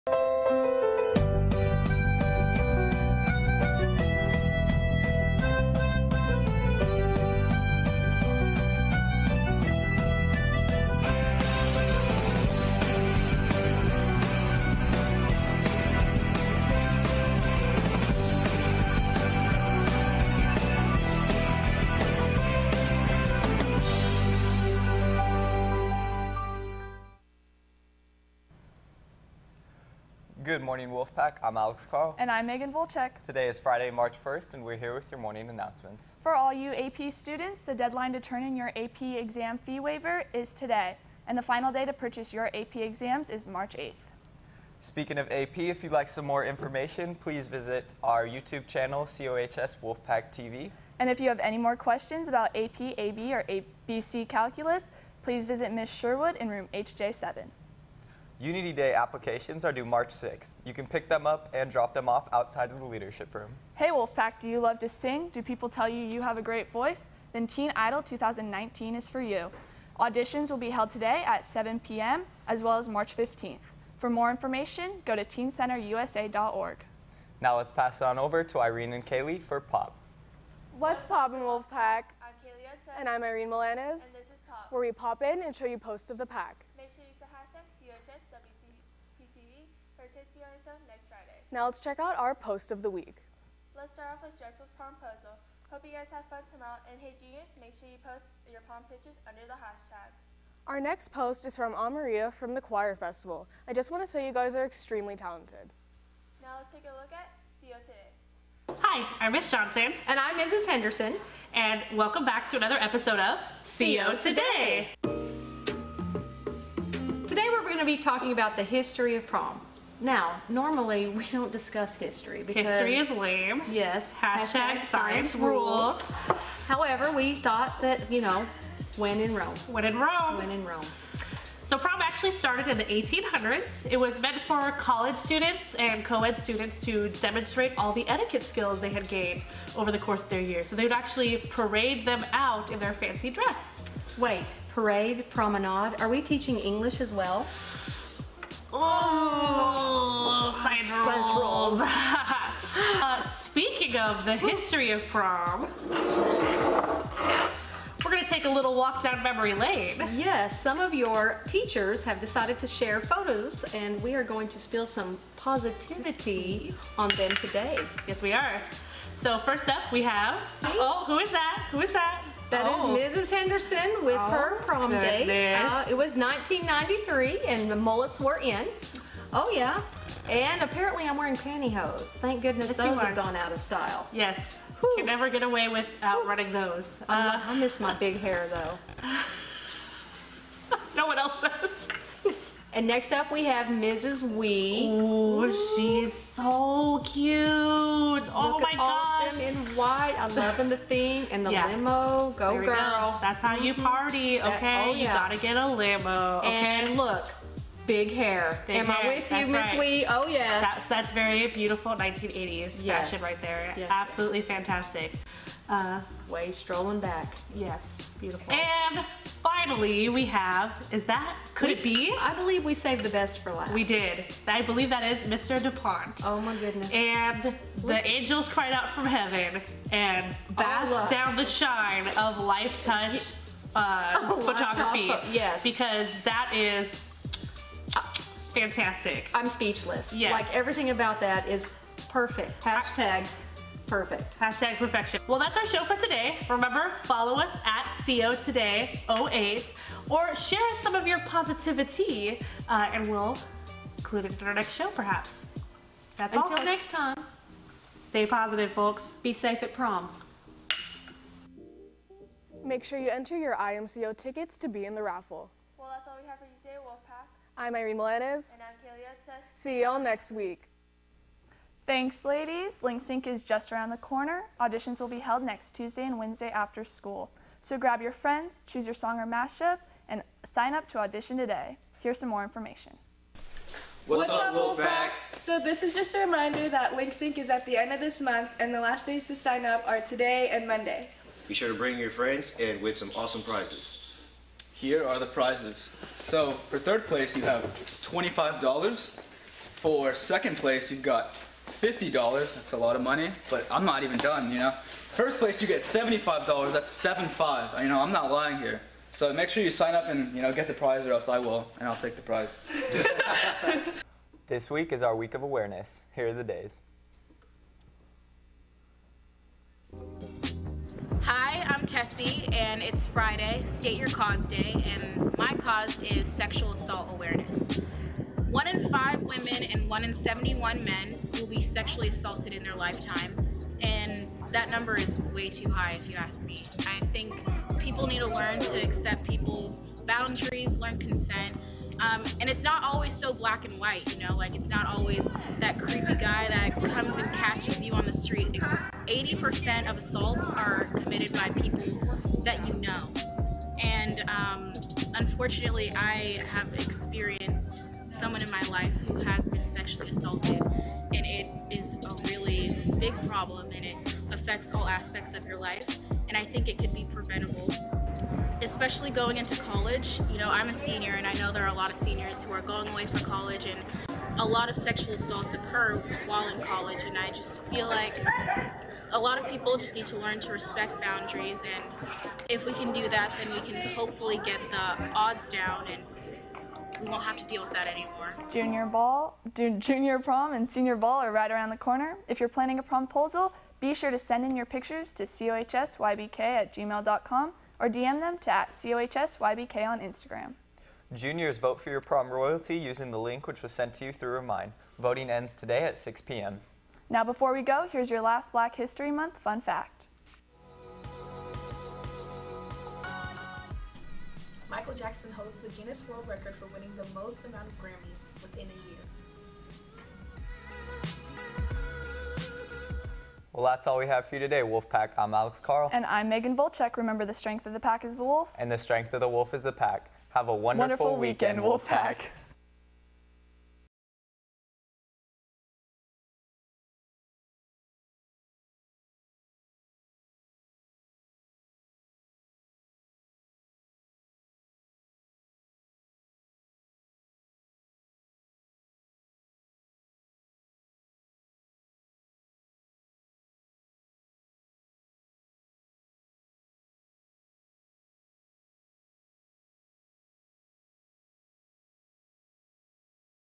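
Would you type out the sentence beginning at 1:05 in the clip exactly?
Do people tell you you have a great voice?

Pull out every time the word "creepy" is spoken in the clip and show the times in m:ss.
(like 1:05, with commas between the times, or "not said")
5:45.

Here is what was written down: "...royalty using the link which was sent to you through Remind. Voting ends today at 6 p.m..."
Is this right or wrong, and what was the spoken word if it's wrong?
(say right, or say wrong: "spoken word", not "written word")
right.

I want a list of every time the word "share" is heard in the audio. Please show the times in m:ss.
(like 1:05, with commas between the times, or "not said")
2:42, 4:10.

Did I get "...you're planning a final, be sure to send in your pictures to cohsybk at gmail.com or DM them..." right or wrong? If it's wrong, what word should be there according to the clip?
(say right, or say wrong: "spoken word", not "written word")
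wrong: "promposal", not "final".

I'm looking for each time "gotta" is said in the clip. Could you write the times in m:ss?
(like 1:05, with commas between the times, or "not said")
3:25.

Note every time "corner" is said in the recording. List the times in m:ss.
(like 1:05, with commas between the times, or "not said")
4:33, 6:31.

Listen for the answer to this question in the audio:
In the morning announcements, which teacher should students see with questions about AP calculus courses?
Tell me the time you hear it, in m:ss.
0:55.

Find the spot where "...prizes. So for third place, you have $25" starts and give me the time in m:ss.
4:55.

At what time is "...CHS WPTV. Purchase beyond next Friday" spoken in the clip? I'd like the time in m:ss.
1:27.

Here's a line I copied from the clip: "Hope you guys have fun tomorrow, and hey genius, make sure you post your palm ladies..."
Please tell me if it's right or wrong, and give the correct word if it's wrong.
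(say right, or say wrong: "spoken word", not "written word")
wrong: "pictures", not "ladies".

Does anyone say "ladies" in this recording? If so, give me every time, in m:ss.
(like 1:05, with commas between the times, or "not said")
4:32.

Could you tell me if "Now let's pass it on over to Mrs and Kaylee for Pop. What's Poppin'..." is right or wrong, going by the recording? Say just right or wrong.
wrong.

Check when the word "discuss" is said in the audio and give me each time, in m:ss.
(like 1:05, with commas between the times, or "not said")
2:01.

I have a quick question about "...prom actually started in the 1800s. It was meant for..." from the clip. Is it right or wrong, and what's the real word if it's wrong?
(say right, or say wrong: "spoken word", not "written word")
right.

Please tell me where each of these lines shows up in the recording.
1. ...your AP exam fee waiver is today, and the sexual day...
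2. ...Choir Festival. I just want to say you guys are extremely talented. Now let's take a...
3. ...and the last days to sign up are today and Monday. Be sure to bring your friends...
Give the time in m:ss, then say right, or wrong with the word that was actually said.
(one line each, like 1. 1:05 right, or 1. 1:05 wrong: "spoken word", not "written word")
1. 0:38 wrong: "final", not "sexual"
2. 1:42 right
3. 4:48 right.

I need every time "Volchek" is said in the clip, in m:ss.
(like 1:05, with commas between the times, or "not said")
0:32, 7:06.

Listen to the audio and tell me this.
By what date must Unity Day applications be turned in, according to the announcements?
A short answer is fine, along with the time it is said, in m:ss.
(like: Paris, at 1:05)
March 6th, at 0:59.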